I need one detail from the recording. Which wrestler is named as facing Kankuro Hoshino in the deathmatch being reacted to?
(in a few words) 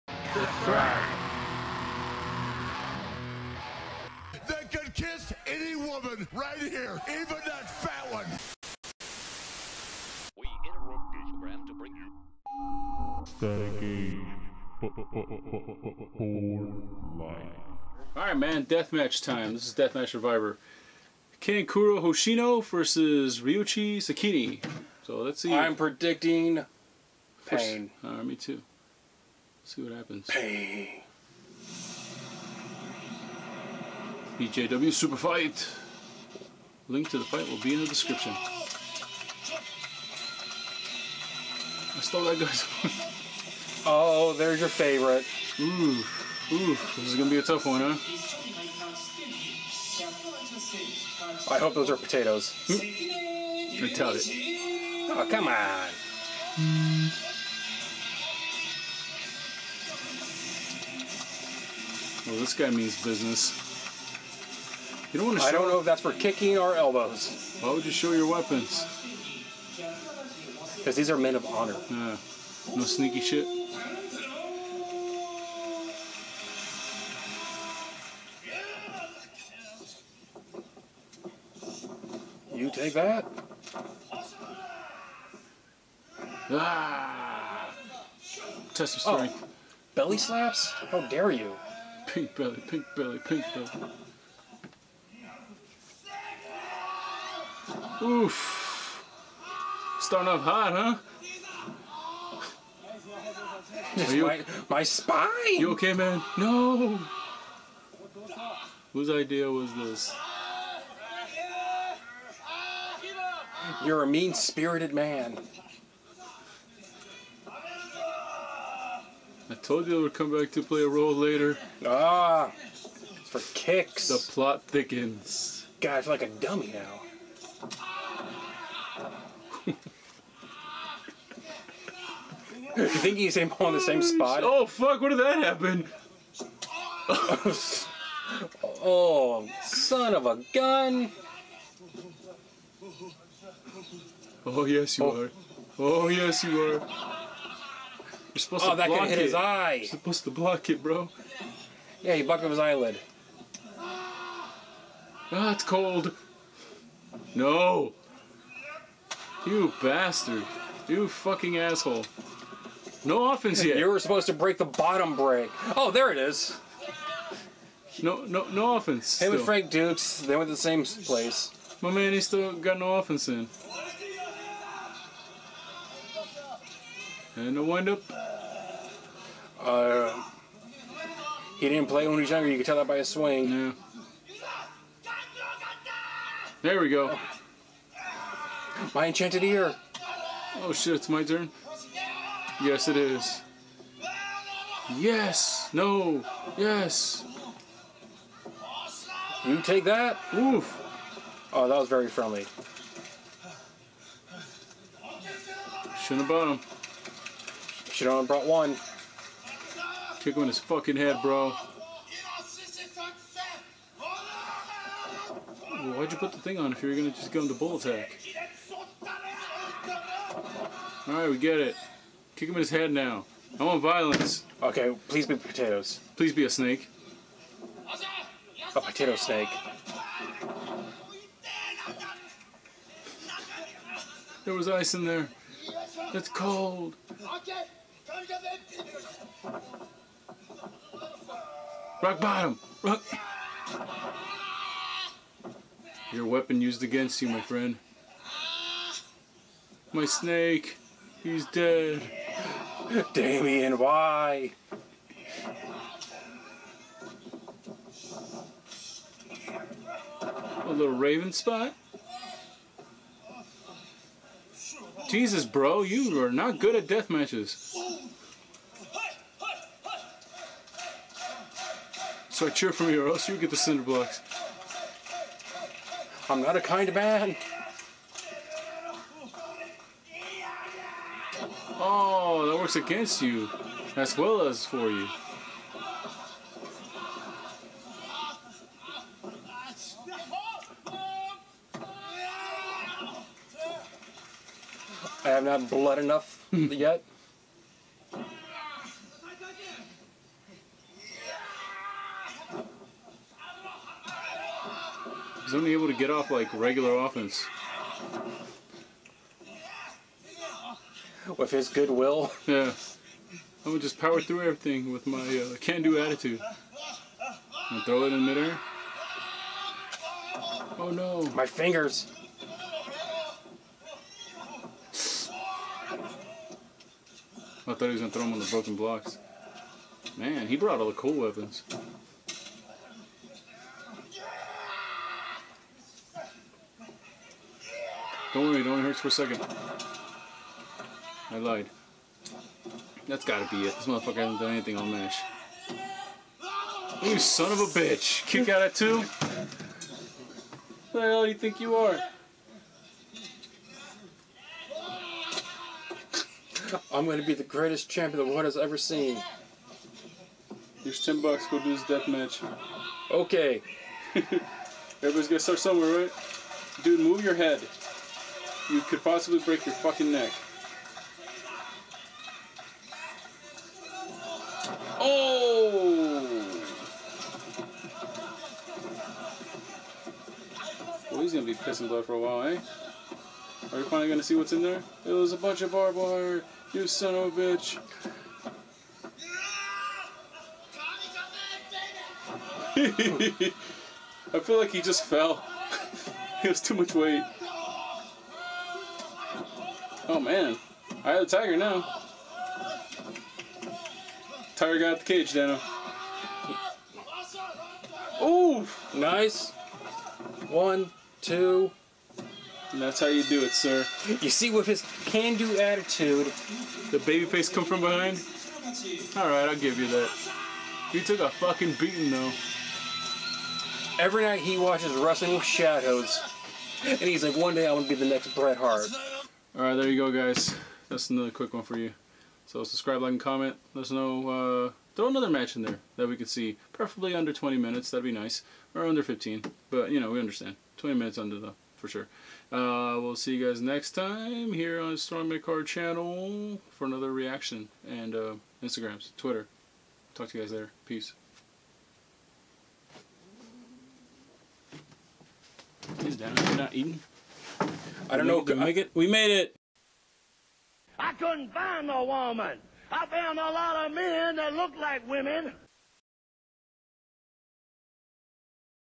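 Ryuichi Sekine.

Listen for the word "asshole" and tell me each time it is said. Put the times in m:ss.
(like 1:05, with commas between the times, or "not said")
2:41.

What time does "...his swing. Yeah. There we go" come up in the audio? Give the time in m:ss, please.
3:02.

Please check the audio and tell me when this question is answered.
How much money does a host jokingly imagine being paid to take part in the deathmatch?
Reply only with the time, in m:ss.
6:01.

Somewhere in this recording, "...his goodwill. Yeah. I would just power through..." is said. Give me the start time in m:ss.
5:11.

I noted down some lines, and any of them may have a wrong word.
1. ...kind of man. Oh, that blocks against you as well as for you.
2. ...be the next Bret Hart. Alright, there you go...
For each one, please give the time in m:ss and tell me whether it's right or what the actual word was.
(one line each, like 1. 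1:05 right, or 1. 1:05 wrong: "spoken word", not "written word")
1. 4:36 wrong: "works", not "blocks"
2. 7:07 right.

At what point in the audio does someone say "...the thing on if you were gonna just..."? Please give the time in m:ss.
3:36.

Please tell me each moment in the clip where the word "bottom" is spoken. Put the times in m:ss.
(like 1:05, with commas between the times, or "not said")
2:44, 3:26, 4:02.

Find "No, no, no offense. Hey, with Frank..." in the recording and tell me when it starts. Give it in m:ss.
2:48.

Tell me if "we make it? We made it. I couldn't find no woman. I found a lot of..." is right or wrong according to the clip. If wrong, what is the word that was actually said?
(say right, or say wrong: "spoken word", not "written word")
right.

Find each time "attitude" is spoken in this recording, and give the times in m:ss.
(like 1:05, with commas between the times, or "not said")
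5:15, 6:55.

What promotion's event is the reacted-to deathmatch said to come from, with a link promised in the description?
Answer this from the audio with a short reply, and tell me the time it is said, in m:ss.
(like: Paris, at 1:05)
BJW Super Fight, at 0:34.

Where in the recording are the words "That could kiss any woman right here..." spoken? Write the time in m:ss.
0:04.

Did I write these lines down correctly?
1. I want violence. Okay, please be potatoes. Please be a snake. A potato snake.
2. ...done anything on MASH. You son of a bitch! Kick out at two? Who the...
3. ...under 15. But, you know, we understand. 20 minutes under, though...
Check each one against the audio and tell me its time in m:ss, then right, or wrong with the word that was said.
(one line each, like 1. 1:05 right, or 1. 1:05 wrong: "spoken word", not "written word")
1. 3:43 right
2. 5:44 right
3. 7:18 right.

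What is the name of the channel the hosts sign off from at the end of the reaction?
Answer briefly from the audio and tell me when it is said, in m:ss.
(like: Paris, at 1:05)
Strong Midcard, at 7:24.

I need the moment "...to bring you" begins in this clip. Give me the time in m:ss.
0:11.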